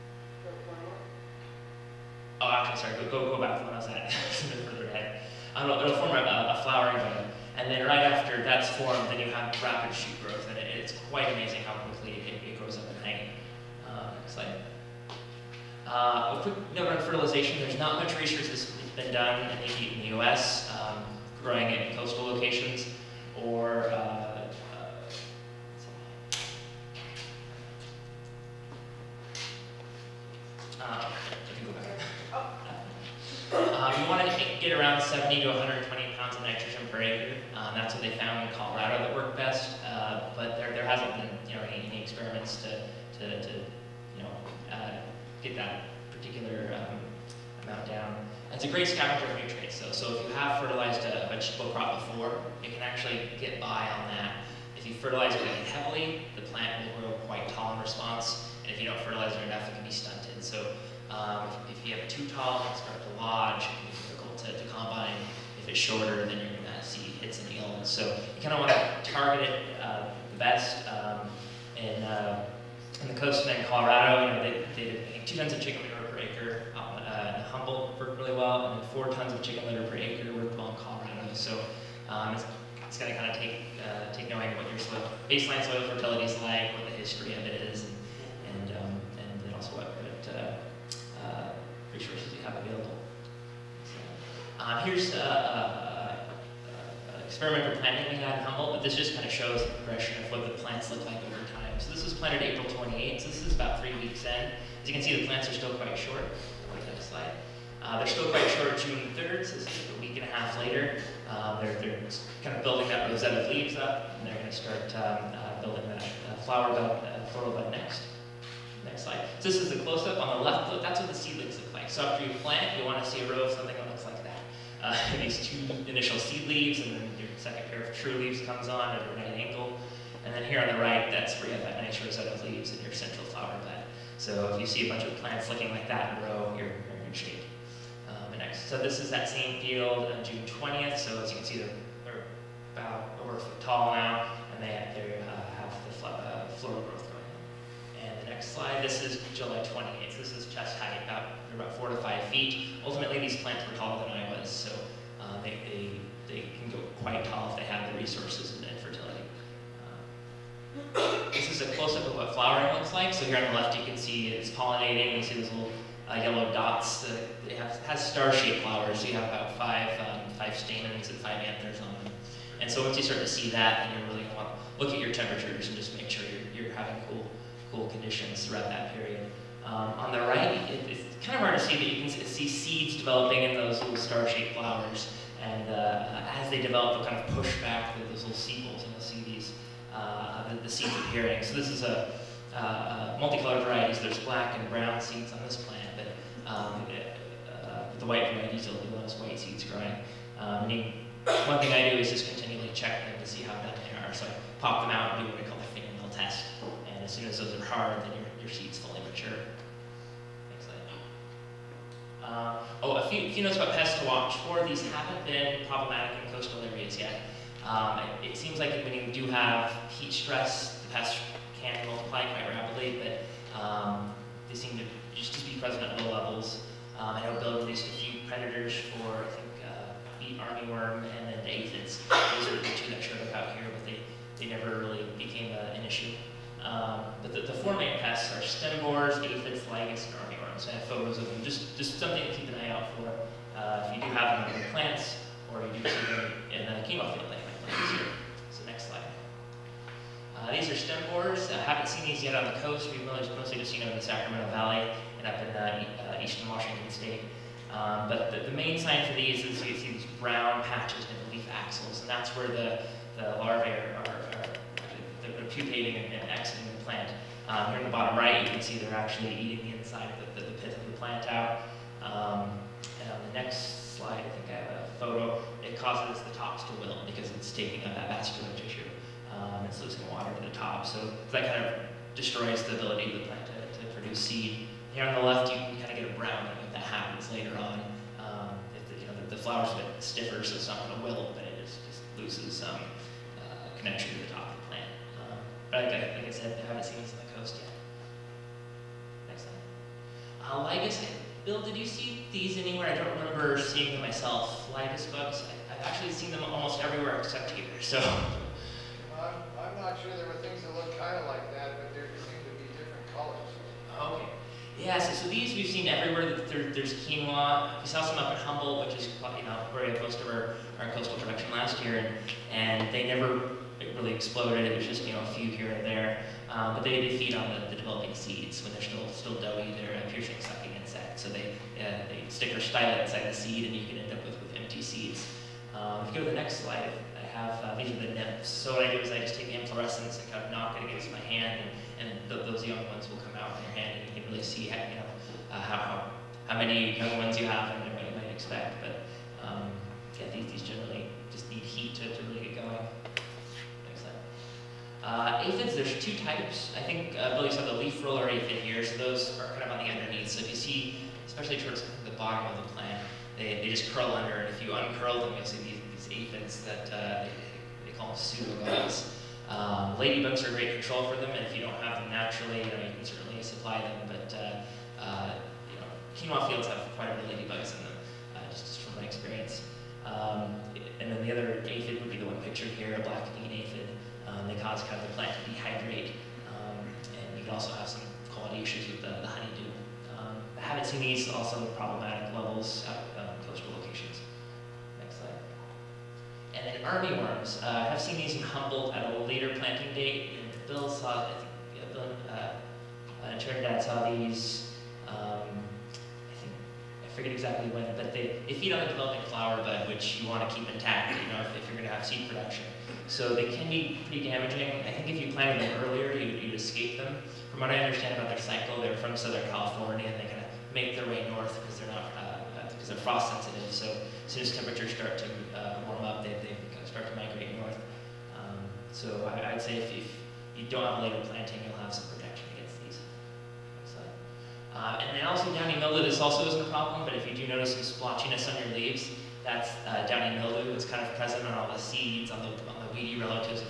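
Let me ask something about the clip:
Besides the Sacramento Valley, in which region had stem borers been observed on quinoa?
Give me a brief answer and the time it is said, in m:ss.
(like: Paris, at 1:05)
eastern Washington state, at 4:16.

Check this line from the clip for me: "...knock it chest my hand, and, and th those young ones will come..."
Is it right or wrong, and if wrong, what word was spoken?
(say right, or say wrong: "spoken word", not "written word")
wrong: "against", not "chest".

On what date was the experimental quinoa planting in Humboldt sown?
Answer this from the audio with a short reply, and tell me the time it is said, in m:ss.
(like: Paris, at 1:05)
April 28, at 1:42.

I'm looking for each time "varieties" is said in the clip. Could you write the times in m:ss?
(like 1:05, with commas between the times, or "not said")
3:13, 3:18.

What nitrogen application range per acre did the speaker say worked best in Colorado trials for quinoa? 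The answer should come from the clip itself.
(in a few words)
70 to 120 pounds.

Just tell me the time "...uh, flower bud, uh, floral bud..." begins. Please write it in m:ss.
1:56.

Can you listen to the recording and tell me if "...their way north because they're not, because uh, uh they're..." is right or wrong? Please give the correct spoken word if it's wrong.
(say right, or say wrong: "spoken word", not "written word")
right.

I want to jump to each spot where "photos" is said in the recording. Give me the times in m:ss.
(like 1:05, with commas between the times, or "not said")
4:00, 4:34.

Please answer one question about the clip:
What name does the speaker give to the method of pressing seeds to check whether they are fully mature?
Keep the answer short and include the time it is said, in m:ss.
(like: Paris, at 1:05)
fingernail test, at 3:25.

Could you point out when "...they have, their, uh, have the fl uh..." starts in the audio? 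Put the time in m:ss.
2:24.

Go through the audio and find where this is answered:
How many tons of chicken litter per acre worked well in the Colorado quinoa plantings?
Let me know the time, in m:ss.
1:18.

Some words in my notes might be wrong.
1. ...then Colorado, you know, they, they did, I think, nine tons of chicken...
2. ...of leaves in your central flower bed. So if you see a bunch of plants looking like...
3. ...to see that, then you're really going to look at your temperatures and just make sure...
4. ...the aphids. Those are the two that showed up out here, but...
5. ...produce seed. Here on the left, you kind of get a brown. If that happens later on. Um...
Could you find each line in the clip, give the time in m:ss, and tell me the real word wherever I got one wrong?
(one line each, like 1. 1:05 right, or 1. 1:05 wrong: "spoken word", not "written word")
1. 1:13 wrong: "two", not "nine"
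2. 2:12 right
3. 2:53 right
4. 3:51 right
5. 4:43 right.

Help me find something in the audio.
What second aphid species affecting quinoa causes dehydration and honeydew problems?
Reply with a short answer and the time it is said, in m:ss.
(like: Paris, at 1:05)
black bean aphid, at 6:23.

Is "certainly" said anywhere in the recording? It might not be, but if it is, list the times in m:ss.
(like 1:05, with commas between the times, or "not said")
6:13.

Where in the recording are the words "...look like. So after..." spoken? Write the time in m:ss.
2:01.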